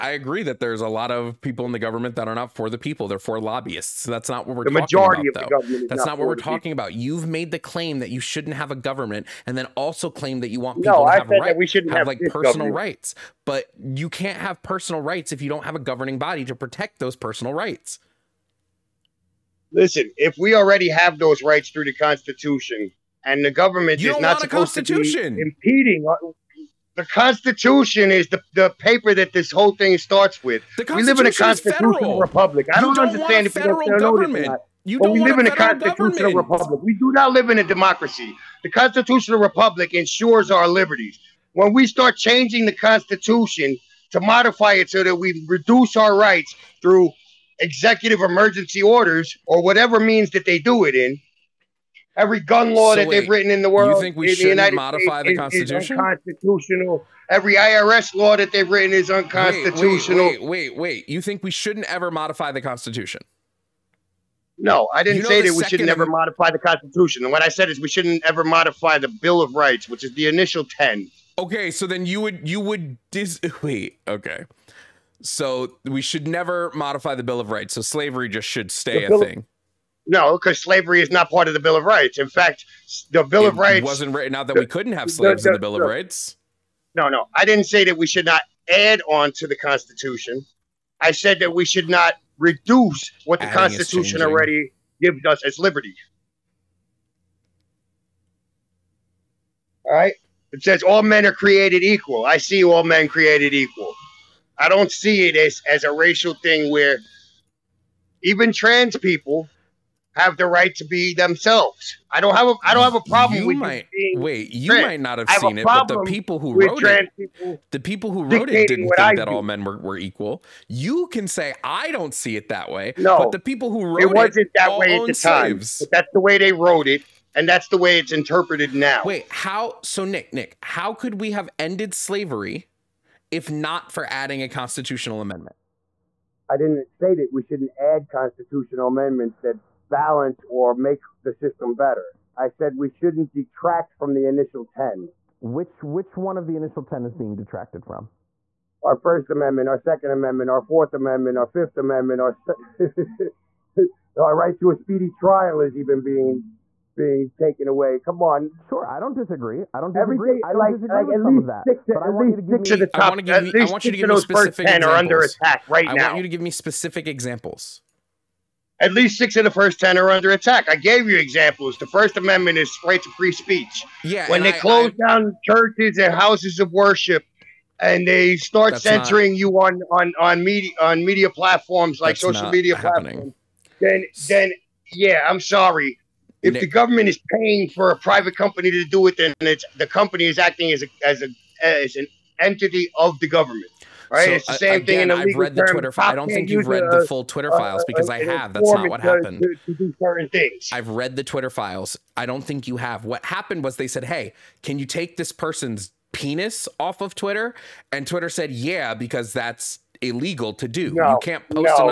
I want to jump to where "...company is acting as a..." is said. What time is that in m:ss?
3:09.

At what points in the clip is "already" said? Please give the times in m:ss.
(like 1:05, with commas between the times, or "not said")
0:20, 1:34.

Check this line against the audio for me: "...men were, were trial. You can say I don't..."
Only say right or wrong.
wrong.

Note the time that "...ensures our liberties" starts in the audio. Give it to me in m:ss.
0:39.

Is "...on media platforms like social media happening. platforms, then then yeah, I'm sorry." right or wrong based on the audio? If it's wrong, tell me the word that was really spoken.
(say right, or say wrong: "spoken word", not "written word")
right.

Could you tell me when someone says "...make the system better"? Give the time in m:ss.
2:20.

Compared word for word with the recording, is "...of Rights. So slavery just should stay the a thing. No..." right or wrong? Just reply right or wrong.
right.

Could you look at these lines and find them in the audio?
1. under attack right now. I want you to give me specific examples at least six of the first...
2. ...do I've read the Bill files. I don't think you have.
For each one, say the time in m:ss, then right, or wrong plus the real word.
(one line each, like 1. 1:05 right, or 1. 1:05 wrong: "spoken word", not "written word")
1. 2:44 right
2. 3:19 wrong: "Twitter", not "Bill".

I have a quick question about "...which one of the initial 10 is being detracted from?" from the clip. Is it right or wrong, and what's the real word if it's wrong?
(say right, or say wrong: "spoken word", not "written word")
right.